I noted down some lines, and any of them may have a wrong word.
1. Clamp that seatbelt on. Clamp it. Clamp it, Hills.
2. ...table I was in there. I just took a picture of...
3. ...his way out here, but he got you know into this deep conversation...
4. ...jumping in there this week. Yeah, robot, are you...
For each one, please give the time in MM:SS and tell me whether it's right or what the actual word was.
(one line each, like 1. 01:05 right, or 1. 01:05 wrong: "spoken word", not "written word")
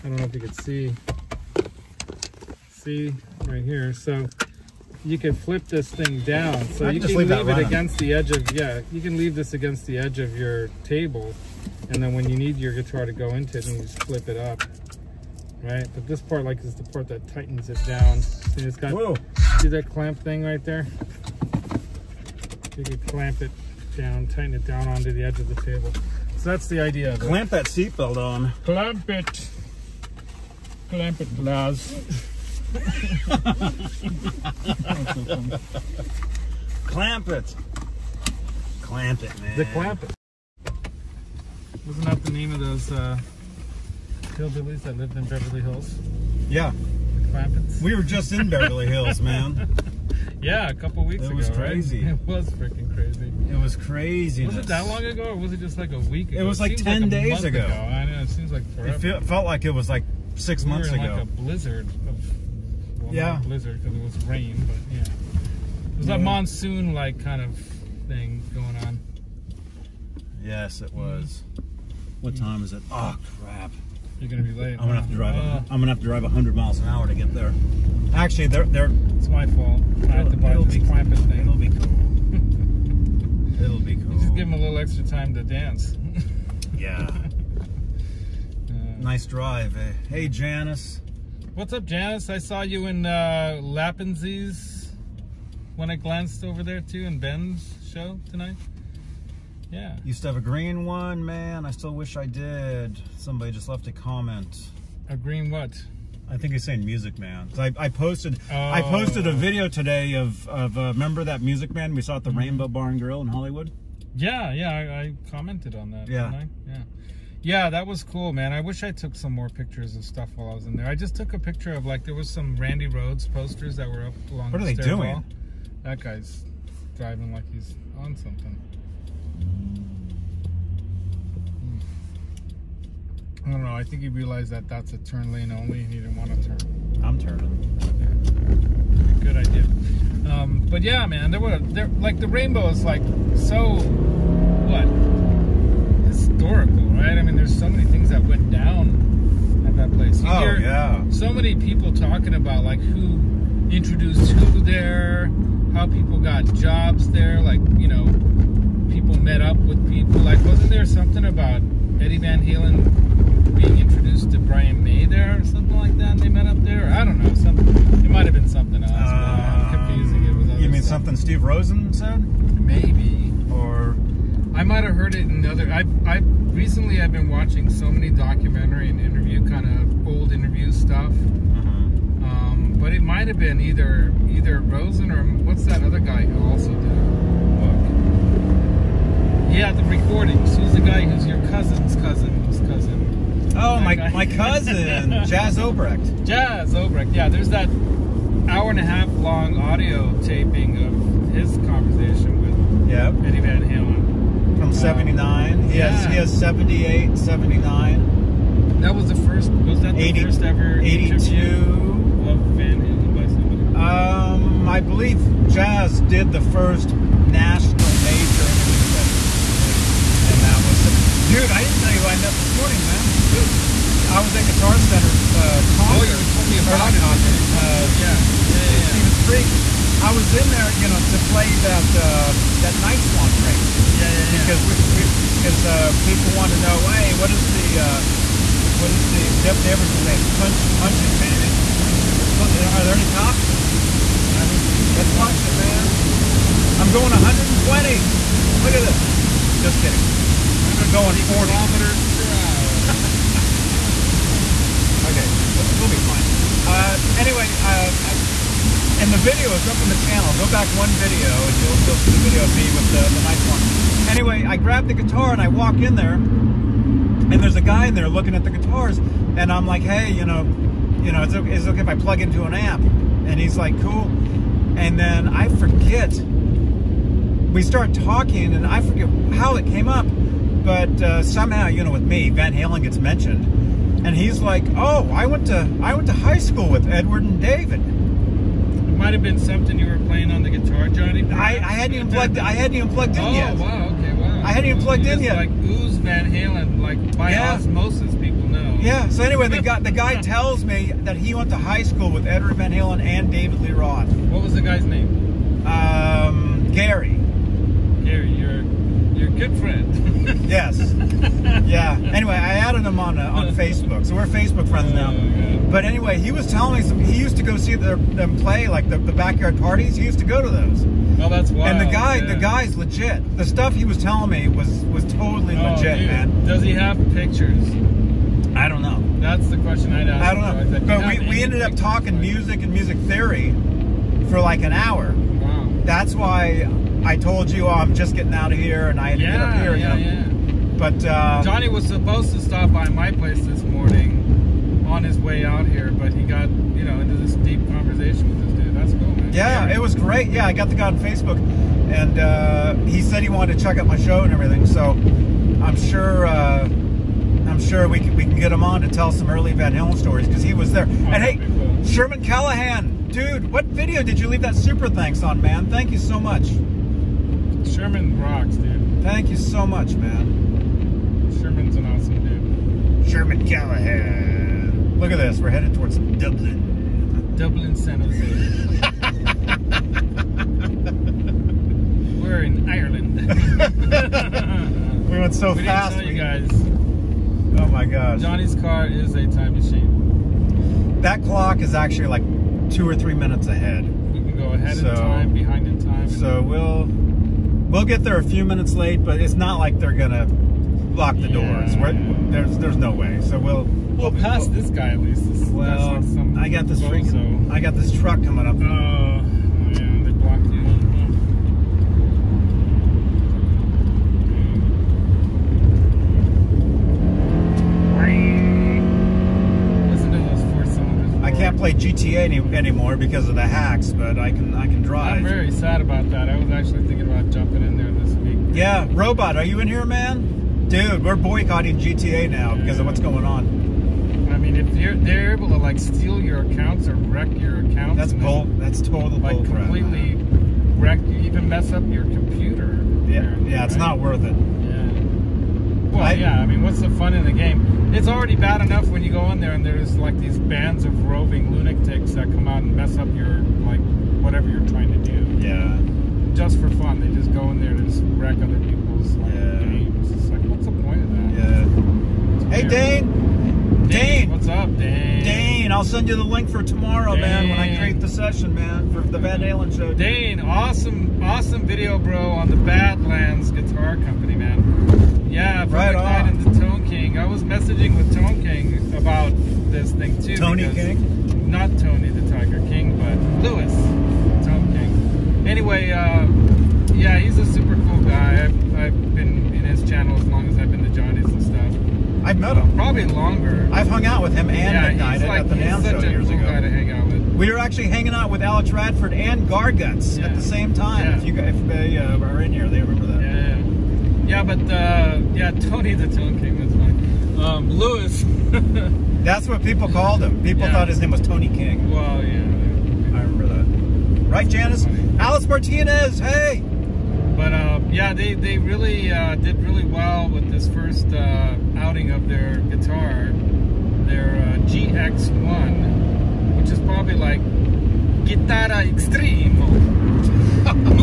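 1. 00:27 wrong: "Lars", not "Hills"
2. 02:00 wrong: "while", not "table"
3. 05:45 right
4. 07:07 right.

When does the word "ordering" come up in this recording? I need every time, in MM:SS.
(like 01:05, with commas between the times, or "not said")
not said.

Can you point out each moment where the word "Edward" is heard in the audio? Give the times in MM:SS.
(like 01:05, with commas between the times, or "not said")
04:46, 05:02.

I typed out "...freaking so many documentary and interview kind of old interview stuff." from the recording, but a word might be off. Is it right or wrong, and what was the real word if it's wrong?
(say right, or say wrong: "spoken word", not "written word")
wrong: "watching", not "freaking".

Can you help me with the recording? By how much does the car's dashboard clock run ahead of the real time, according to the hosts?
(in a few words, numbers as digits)
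2 or 3 minutes.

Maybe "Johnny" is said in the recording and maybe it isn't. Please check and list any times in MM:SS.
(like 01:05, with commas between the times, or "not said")
04:50, 05:41, 06:28, 08:10.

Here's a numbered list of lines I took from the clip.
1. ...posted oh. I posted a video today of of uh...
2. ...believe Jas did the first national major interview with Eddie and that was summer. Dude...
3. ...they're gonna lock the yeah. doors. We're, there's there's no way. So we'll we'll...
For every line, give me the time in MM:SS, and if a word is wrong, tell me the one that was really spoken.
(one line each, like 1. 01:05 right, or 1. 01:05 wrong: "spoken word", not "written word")
1. 01:47 right
2. 03:34 right
3. 06:39 right.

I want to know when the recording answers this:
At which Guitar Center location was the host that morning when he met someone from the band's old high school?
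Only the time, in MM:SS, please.
03:48.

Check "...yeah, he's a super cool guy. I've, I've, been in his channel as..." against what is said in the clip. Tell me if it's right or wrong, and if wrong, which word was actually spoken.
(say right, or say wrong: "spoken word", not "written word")
right.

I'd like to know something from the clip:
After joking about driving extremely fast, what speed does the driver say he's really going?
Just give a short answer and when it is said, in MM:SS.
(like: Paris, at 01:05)
40 kilometers per hour, at 04:11.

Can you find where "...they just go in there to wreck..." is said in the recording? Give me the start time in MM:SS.
07:36.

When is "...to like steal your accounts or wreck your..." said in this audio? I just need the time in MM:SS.
07:15.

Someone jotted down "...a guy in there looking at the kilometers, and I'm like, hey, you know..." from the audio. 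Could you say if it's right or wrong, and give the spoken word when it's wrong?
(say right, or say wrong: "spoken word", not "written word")
wrong: "guitars", not "kilometers".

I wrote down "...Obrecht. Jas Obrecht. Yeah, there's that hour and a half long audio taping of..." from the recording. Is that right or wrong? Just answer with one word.
right.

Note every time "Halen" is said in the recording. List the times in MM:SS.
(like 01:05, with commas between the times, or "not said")
02:42, 03:23, 03:32, 04:42, 04:56, 05:02, 05:59, 07:49.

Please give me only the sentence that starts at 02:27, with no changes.
I mean, there's so many things that went down at that place.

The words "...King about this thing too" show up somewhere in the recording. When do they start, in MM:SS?
07:58.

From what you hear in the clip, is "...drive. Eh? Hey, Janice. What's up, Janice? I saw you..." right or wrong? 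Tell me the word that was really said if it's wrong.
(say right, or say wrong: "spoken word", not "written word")
right.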